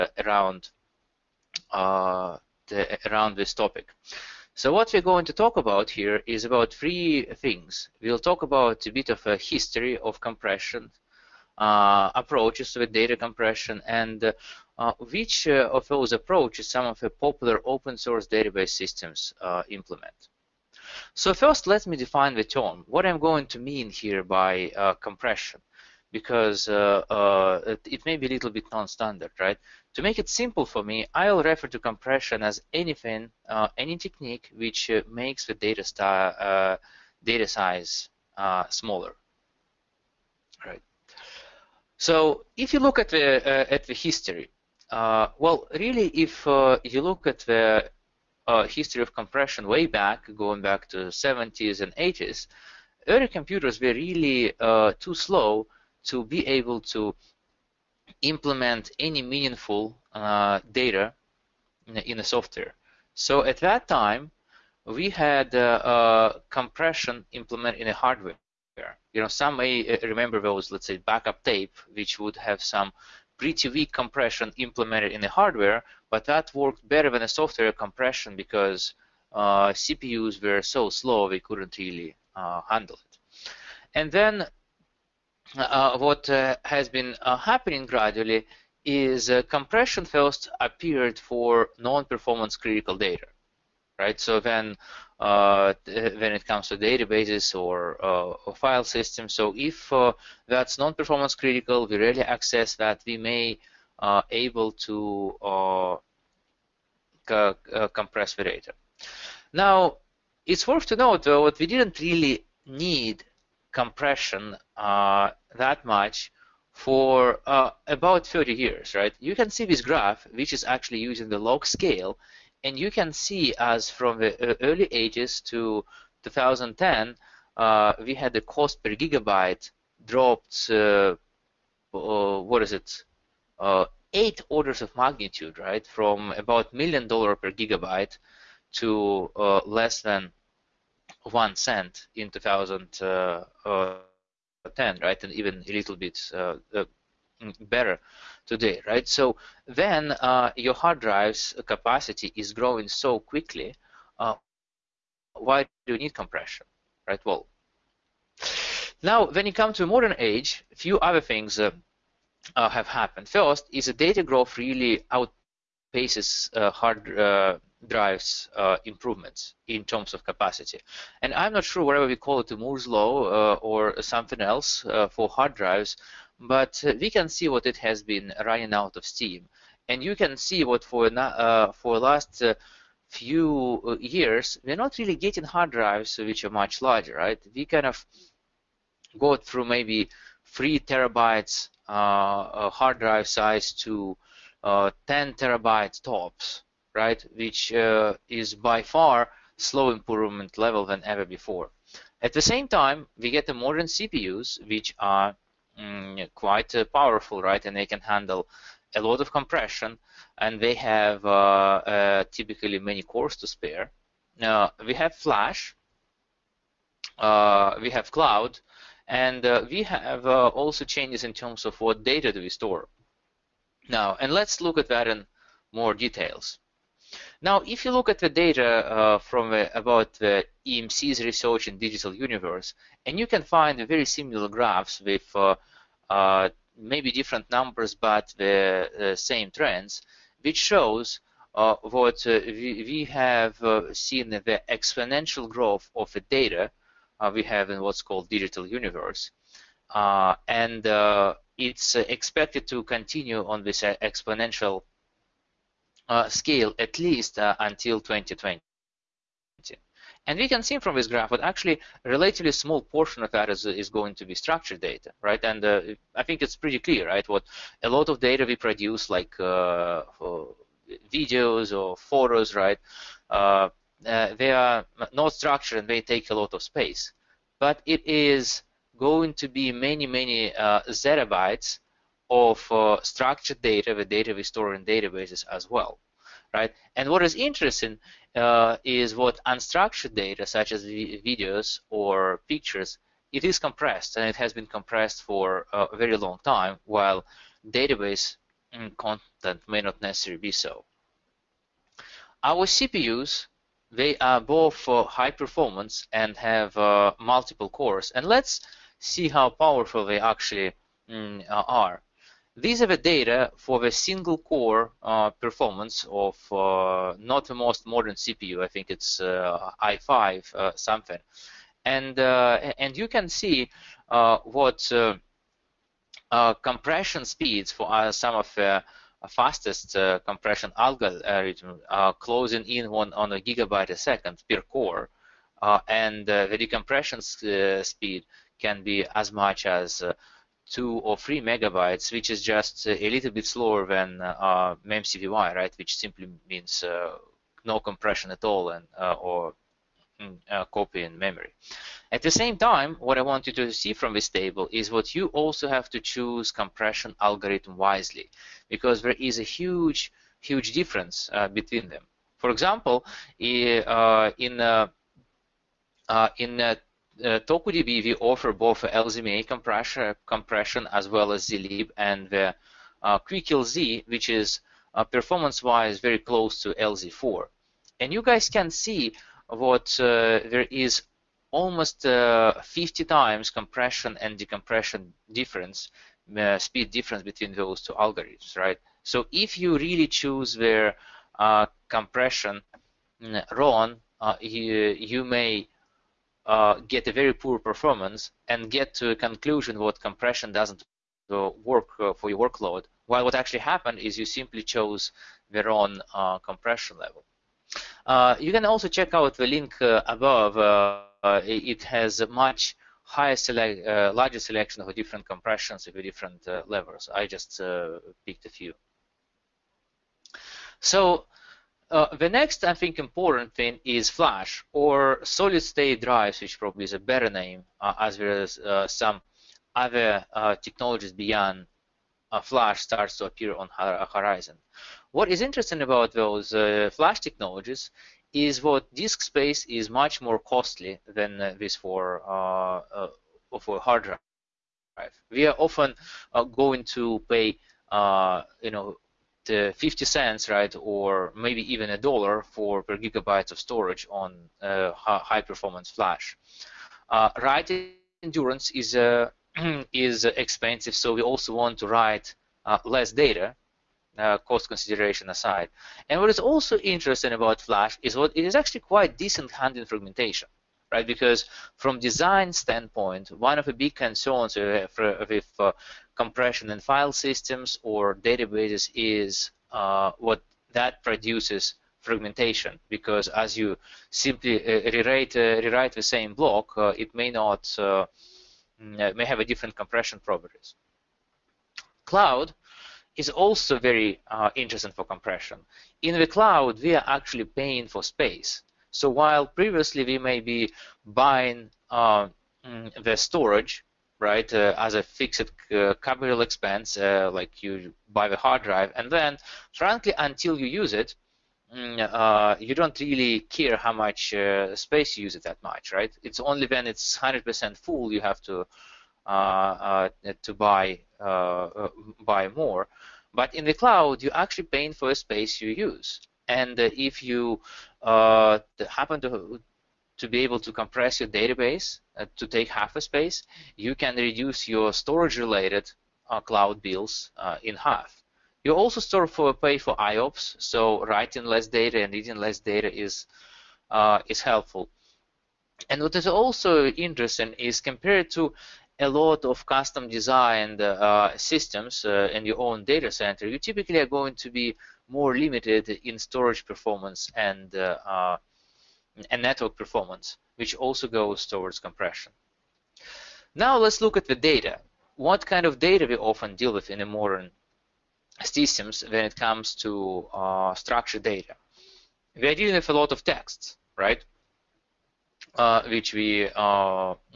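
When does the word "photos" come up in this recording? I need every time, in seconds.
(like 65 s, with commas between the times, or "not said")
271 s.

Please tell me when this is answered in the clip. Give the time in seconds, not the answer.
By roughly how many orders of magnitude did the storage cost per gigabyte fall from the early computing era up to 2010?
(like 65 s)
134 s.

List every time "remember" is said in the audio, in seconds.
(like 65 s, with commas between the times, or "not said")
70 s.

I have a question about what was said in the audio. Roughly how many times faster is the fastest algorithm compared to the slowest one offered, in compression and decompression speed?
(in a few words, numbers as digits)
50 times.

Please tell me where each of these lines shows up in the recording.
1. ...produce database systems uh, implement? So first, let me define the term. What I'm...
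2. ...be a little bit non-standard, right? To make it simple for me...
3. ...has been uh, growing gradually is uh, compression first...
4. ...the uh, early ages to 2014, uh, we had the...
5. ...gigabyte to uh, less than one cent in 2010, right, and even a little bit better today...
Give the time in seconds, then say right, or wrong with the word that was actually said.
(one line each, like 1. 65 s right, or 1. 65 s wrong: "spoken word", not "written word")
1. 17 s wrong: "source", not "produce"
2. 28 s right
3. 86 s wrong: "happening", not "growing"
4. 124 s wrong: "2010", not "2014"
5. 137 s right.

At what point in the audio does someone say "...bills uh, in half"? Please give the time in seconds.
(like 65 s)
536 s.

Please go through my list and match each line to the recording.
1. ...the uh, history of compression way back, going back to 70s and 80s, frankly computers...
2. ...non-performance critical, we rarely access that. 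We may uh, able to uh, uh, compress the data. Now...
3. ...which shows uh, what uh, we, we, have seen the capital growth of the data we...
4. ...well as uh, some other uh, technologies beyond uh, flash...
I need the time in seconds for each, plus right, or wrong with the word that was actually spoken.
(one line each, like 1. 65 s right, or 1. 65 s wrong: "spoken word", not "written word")
1. 47 s wrong: "early", not "frankly"
2. 100 s right
3. 240 s wrong: "exponential", not "capital"
4. 428 s right.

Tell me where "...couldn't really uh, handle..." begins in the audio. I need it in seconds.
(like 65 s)
81 s.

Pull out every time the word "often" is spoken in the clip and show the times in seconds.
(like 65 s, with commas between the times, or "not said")
445 s, 566 s.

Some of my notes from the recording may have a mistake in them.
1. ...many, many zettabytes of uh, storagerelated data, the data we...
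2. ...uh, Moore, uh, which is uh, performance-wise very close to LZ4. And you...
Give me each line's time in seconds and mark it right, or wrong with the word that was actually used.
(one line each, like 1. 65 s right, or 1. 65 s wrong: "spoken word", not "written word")
1. 279 s wrong: "structured", not "storagerelated"
2. 373 s wrong: "QuickLZ", not "Moore".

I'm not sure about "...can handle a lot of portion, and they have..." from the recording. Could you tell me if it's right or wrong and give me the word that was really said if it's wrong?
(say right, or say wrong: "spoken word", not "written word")
wrong: "compression", not "portion".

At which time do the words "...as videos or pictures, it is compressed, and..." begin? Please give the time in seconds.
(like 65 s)
290 s.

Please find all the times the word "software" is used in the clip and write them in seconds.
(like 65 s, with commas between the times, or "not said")
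62 s, 77 s.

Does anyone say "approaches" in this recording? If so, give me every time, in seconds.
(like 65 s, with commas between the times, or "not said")
11 s, 16 s.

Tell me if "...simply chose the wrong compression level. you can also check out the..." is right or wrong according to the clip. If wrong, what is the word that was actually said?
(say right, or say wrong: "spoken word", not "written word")
right.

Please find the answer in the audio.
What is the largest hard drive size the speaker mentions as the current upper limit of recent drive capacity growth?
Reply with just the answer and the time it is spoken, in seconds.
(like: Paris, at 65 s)
10 terabytes, at 195 s.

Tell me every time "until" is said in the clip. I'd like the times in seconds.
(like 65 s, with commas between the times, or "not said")
257 s, 510 s.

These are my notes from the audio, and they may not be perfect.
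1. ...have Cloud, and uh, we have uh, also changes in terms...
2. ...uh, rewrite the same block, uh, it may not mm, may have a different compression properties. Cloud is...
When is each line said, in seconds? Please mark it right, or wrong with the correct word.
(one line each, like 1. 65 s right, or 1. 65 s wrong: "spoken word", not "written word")
1. 217 s right
2. 485 s right.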